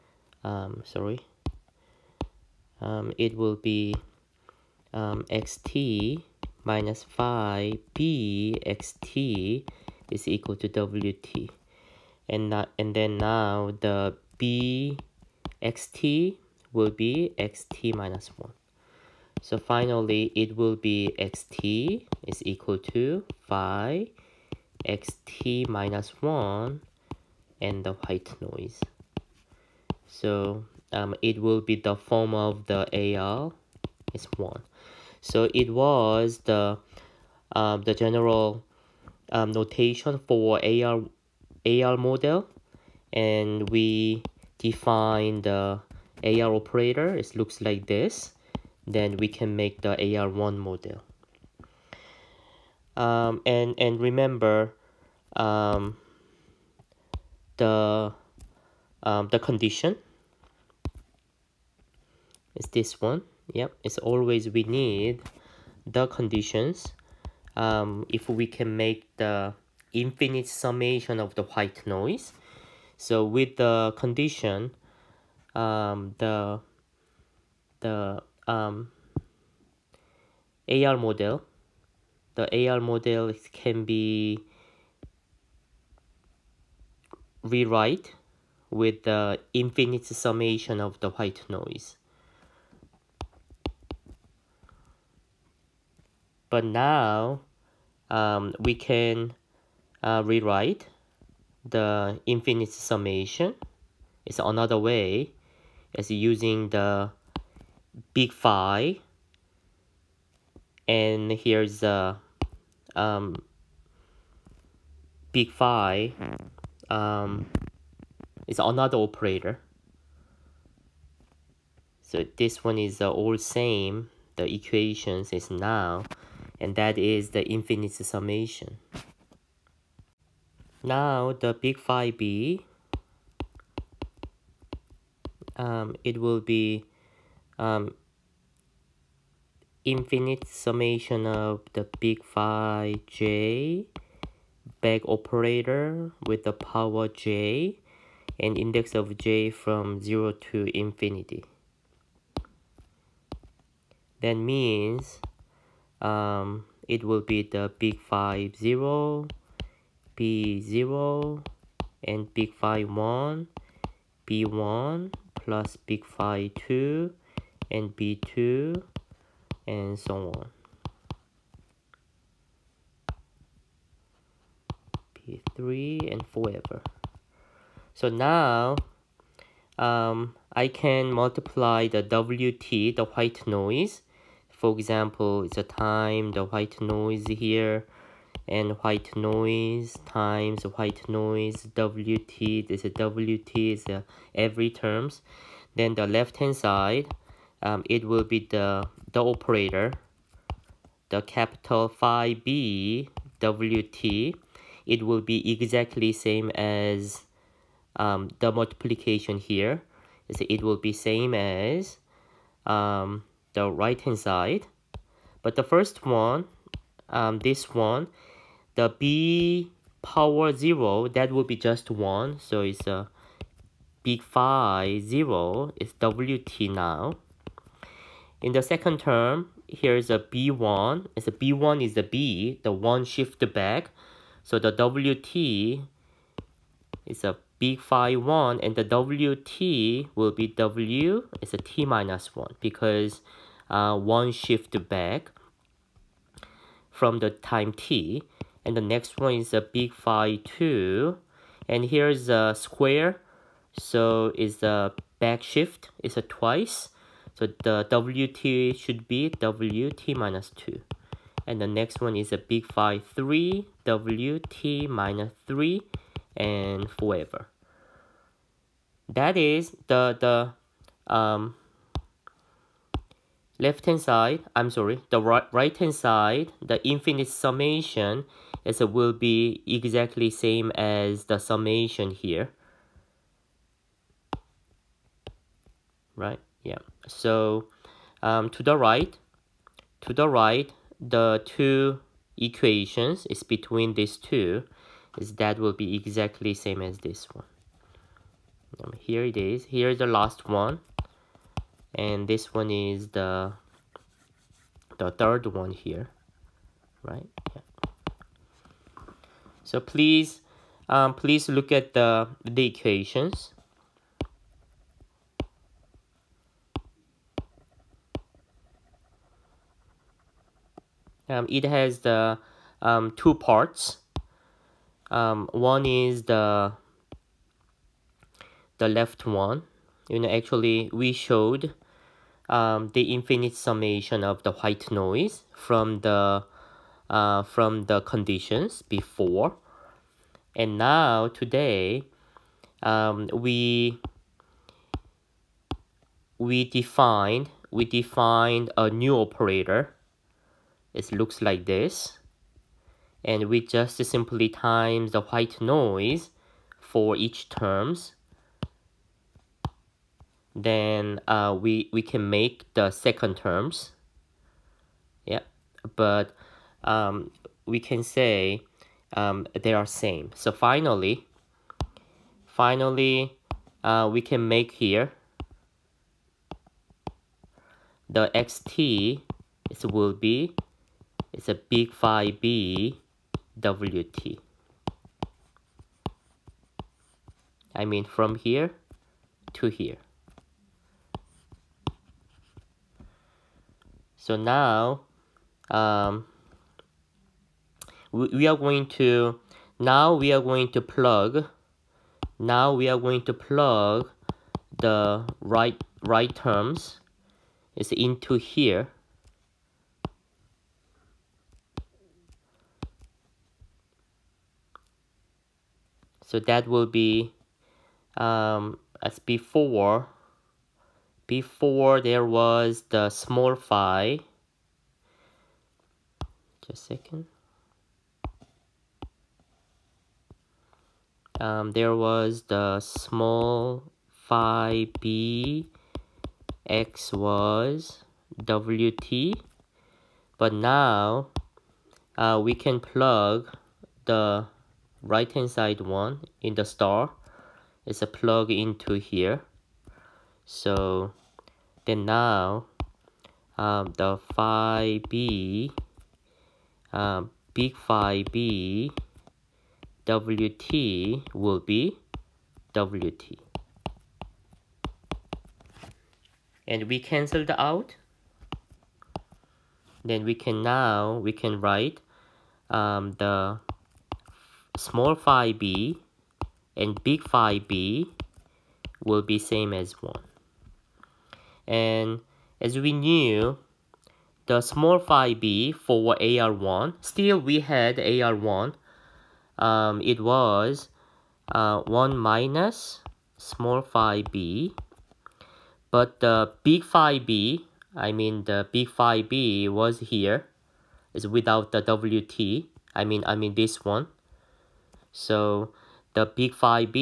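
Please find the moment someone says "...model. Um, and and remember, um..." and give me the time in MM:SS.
00:50.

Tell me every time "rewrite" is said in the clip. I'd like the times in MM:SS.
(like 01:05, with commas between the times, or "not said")
01:27, 01:40.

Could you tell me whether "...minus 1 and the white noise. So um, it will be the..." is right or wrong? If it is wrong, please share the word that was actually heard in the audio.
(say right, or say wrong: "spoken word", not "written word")
right.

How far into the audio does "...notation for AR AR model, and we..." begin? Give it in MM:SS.
00:39.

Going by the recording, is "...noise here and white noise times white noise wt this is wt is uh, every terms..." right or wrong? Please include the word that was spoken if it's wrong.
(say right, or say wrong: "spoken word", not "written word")
right.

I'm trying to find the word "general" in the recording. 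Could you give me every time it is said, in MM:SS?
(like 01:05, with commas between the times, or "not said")
00:37.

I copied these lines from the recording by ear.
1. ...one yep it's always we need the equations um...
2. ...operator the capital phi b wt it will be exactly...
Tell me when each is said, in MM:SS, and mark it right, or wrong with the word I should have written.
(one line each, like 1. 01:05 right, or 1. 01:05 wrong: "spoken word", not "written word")
1. 01:03 wrong: "conditions", not "equations"
2. 03:19 right.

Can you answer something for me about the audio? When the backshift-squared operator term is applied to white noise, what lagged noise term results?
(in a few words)
wt minus 2.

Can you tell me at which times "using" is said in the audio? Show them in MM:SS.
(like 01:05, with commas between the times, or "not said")
01:46.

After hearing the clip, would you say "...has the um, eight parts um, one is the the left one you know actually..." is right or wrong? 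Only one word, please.
wrong.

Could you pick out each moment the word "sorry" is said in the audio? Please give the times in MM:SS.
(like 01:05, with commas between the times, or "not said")
00:00, 04:34.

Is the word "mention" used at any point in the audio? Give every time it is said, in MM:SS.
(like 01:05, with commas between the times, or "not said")
not said.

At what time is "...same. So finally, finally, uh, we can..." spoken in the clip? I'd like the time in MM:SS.
06:09.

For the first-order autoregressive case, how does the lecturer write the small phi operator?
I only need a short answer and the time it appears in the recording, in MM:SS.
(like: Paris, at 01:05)
1 minus small phi b, at 08:11.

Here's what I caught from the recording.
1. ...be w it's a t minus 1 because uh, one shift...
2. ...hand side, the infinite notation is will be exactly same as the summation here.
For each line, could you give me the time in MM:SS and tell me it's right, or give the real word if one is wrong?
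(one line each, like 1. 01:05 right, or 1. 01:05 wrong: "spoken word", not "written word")
1. 04:00 right
2. 04:35 wrong: "summation", not "notation".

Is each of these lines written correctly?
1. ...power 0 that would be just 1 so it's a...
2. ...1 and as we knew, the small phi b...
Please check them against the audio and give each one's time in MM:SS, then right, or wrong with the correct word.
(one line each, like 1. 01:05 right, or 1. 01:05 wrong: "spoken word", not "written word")
1. 03:40 right
2. 08:00 right.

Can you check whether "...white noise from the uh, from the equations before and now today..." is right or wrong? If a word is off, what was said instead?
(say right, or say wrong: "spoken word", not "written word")
wrong: "conditions", not "equations".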